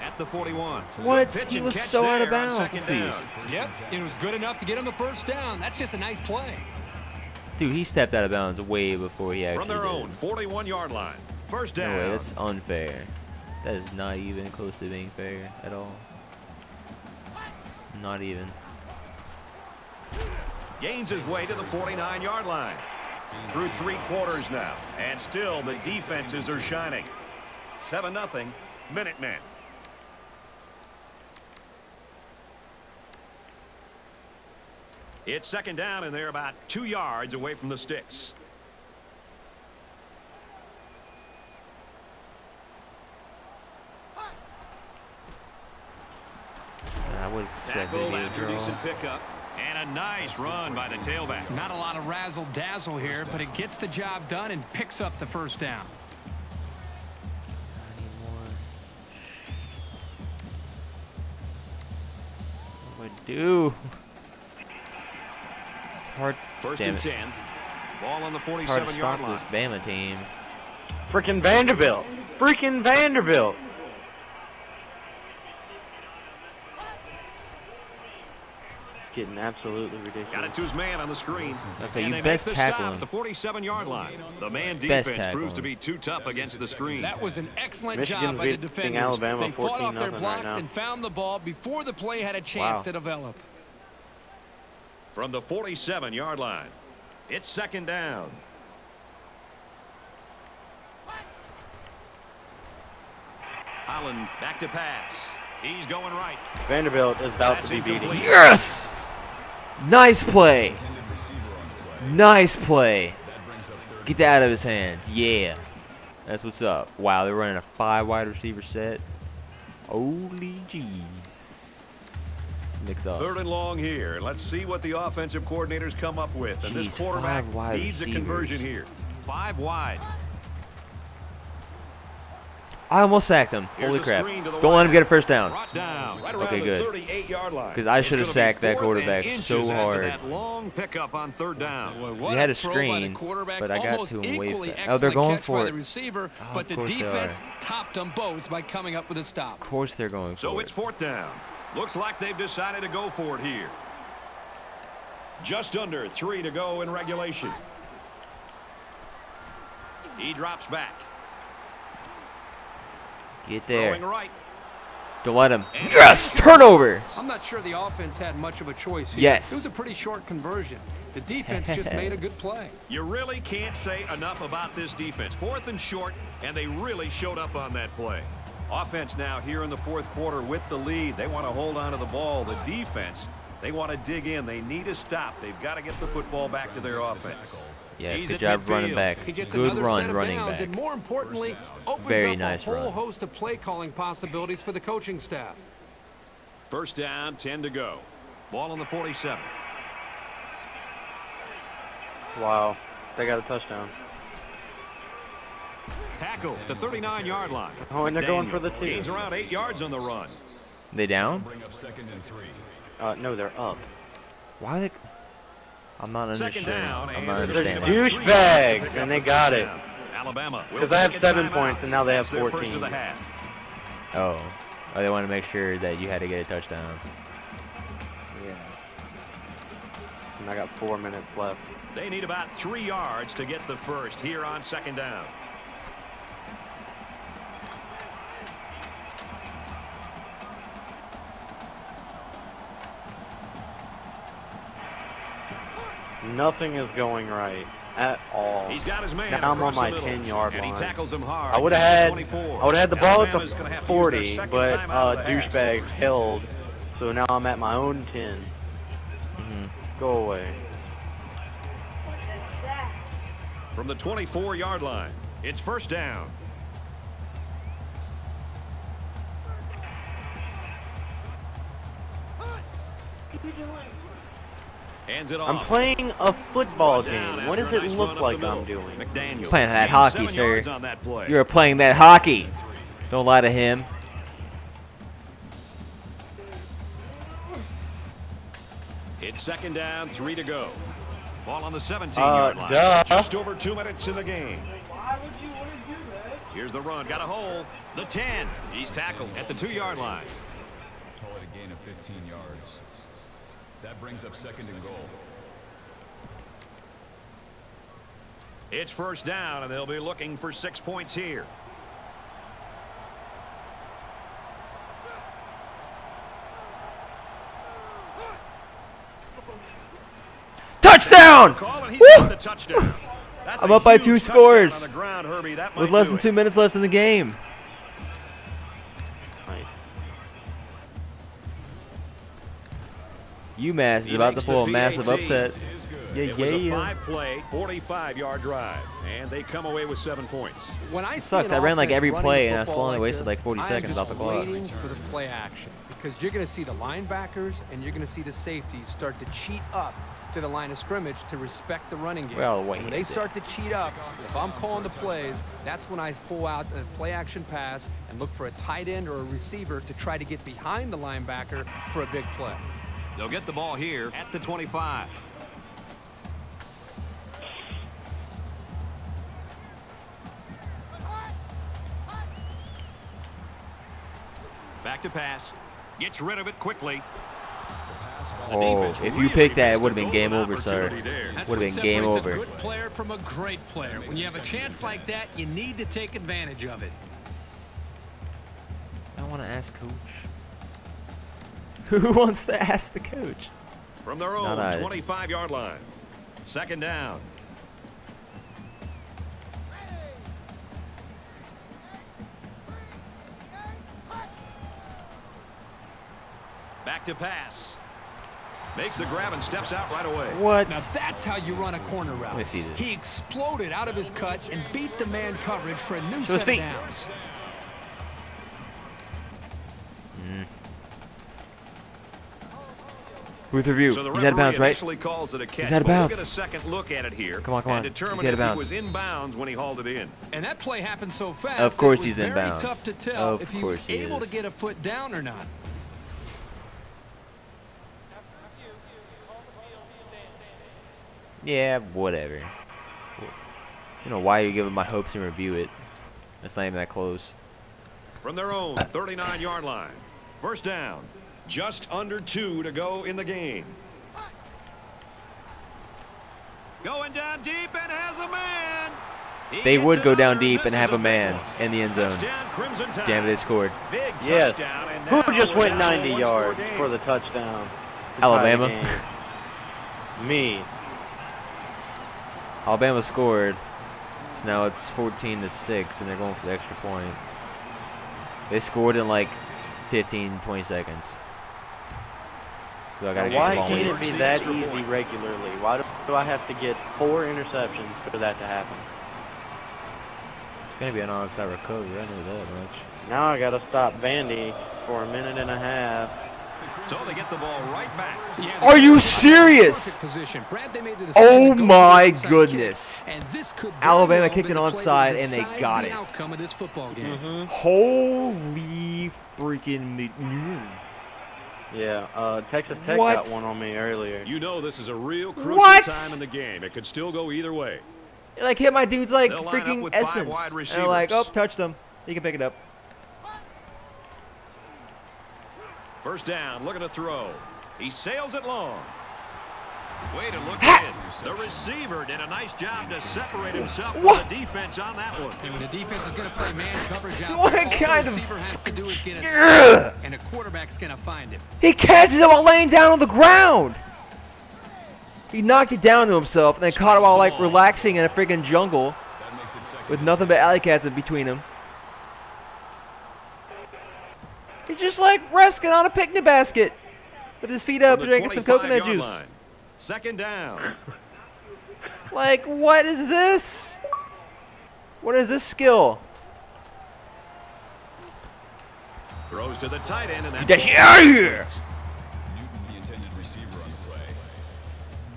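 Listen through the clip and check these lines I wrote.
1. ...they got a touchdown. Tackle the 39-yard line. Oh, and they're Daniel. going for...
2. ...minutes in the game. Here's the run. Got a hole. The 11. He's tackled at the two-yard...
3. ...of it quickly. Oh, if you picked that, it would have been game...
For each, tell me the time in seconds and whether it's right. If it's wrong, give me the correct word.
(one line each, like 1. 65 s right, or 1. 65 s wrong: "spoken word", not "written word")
1. 203 s right
2. 293 s wrong: "10", not "11"
3. 376 s right.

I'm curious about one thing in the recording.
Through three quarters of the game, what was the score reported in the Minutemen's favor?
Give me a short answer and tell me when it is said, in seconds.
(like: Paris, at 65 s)
7-0, at 27 s.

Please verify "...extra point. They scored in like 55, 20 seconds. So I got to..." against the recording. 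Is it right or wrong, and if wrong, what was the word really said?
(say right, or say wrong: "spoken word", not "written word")
wrong: "15", not "55".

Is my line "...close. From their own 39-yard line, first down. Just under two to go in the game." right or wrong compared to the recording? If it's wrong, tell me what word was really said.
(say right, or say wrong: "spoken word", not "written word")
right.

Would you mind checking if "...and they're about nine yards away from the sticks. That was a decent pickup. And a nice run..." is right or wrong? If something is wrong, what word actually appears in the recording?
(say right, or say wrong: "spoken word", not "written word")
wrong: "two", not "nine".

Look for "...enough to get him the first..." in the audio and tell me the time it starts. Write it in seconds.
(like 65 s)
4 s.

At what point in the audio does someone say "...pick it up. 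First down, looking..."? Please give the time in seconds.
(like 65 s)
522 s.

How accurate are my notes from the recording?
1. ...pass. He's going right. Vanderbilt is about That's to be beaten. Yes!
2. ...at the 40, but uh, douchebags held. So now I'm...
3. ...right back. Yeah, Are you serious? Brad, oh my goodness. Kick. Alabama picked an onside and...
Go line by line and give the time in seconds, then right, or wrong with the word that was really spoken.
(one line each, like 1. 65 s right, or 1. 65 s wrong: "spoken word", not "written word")
1. 104 s right
2. 253 s right
3. 497 s wrong: "kicked", not "picked".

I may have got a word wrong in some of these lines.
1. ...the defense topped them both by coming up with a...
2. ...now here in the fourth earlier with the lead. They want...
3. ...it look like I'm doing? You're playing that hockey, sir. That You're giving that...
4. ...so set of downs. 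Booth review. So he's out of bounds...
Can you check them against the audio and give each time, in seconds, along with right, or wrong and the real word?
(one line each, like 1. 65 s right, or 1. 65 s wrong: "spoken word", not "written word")
1. 146 s right
2. 179 s wrong: "quarter", not "earlier"
3. 277 s wrong: "playing", not "giving"
4. 416 s right.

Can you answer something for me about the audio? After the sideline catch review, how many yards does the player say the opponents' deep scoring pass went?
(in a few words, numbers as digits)
90.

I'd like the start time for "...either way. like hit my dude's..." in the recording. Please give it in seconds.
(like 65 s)
517 s.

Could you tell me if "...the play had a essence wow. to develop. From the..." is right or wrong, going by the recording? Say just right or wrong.
wrong.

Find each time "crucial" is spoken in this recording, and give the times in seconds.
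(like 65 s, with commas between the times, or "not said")
515 s.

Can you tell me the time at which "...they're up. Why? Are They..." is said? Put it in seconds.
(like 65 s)
213 s.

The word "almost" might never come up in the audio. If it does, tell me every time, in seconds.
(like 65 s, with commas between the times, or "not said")
133 s.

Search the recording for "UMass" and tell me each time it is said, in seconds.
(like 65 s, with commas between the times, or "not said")
333 s.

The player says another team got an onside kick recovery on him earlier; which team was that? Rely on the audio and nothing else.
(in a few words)
Texas Tech.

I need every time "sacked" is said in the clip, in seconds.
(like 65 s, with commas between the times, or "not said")
133 s, 138 s.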